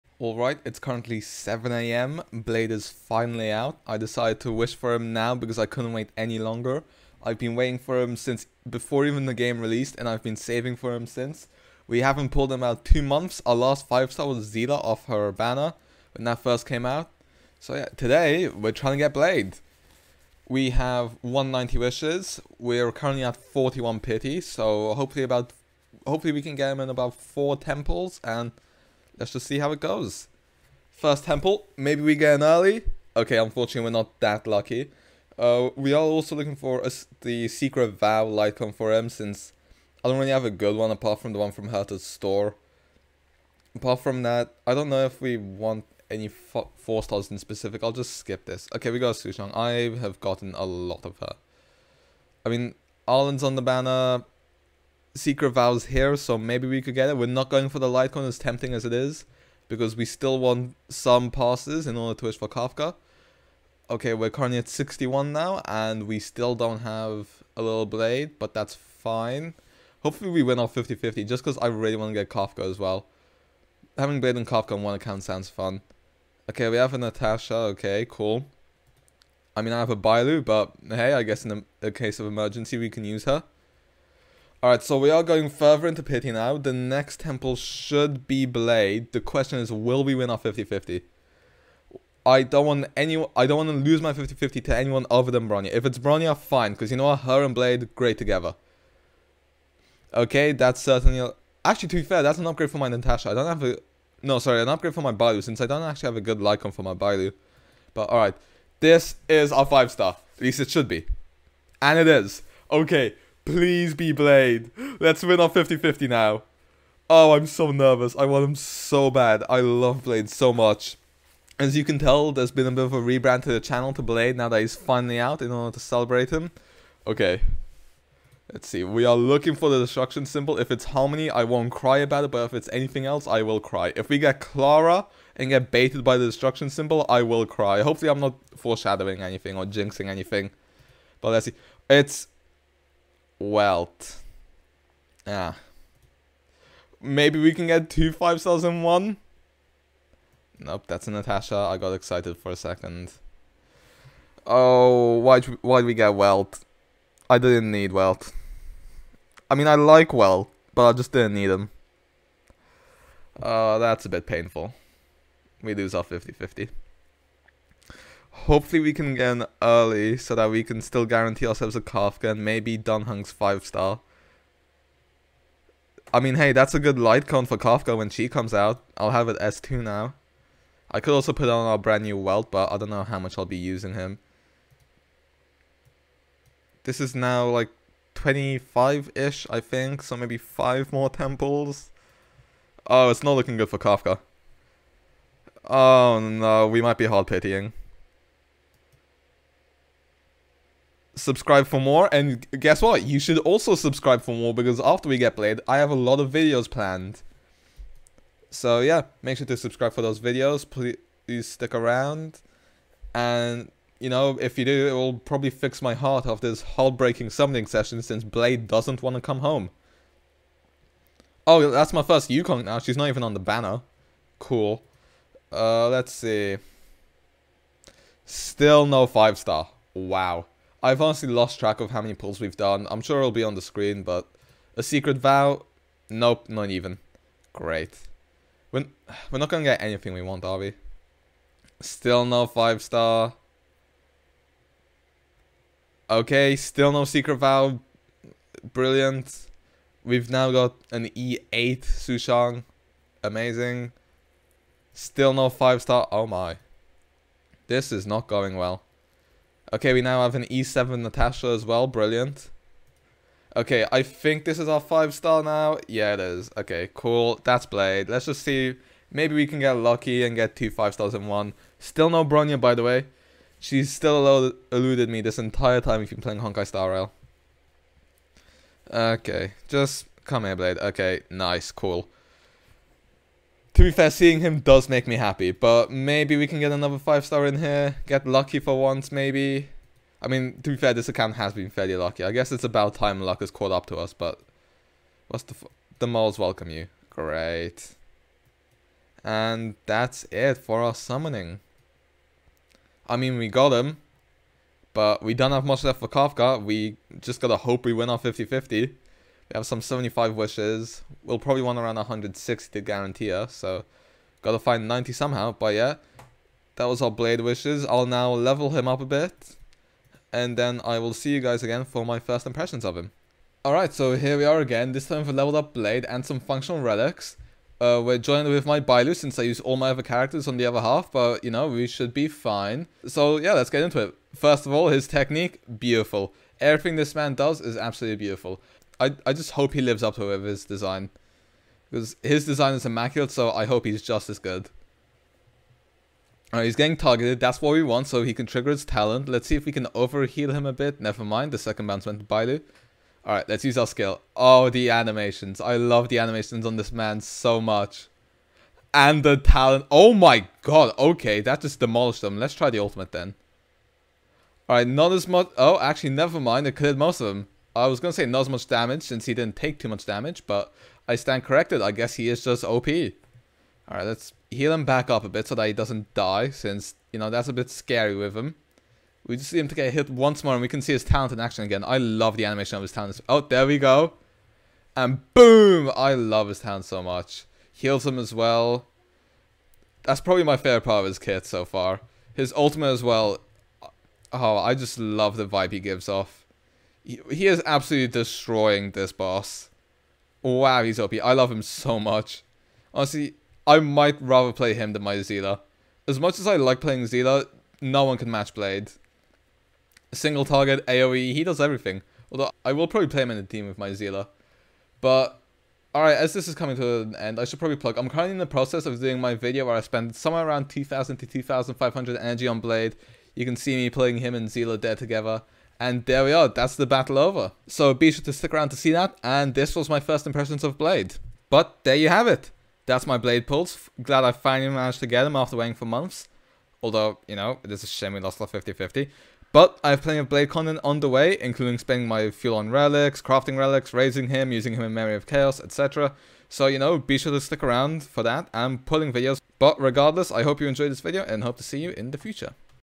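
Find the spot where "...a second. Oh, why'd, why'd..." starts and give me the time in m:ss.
2:32.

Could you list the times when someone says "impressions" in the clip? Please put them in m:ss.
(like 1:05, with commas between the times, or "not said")
5:22, 7:10.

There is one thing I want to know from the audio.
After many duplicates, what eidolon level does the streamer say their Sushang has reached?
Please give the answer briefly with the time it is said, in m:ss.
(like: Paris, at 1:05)
E8, at 4:11.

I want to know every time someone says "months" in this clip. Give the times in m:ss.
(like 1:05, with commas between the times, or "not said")
0:13, 7:15.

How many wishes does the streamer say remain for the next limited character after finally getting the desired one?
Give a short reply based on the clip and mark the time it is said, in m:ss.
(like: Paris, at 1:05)
75, at 5:09.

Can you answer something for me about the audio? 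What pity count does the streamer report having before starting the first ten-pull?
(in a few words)
41.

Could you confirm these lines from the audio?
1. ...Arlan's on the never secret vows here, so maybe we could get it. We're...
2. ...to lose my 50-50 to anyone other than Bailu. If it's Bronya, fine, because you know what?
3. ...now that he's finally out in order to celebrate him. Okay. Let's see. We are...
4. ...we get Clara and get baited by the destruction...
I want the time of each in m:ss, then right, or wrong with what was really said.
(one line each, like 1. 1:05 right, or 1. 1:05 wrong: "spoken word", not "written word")
1. 0:53 wrong: "banner", not "never"
2. 1:33 wrong: "Bronya", not "Bailu"
3. 2:04 right
4. 2:14 right.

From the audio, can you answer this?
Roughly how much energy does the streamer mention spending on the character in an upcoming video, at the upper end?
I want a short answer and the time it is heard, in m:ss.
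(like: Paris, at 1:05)
2,500, at 7:01.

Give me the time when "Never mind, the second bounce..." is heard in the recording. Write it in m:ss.
5:51.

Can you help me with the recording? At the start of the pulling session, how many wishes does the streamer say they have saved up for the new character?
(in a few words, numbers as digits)
190.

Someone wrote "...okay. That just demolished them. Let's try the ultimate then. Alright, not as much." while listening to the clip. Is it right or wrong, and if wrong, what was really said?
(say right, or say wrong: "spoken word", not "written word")
right.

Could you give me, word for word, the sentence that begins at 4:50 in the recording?
I mean, to be fair, this account has been fairly lucky.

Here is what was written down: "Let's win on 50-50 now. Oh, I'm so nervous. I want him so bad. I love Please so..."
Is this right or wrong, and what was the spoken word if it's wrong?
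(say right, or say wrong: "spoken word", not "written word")
wrong: "Blade", not "Please".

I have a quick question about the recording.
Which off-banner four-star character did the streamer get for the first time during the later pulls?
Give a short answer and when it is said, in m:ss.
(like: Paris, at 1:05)
Yukong, at 3:42.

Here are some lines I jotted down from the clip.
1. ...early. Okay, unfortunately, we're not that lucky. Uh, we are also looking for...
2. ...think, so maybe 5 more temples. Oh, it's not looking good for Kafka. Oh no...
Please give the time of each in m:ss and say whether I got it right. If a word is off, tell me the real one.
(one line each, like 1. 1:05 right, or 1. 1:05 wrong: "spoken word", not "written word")
1. 0:32 right
2. 3:09 right.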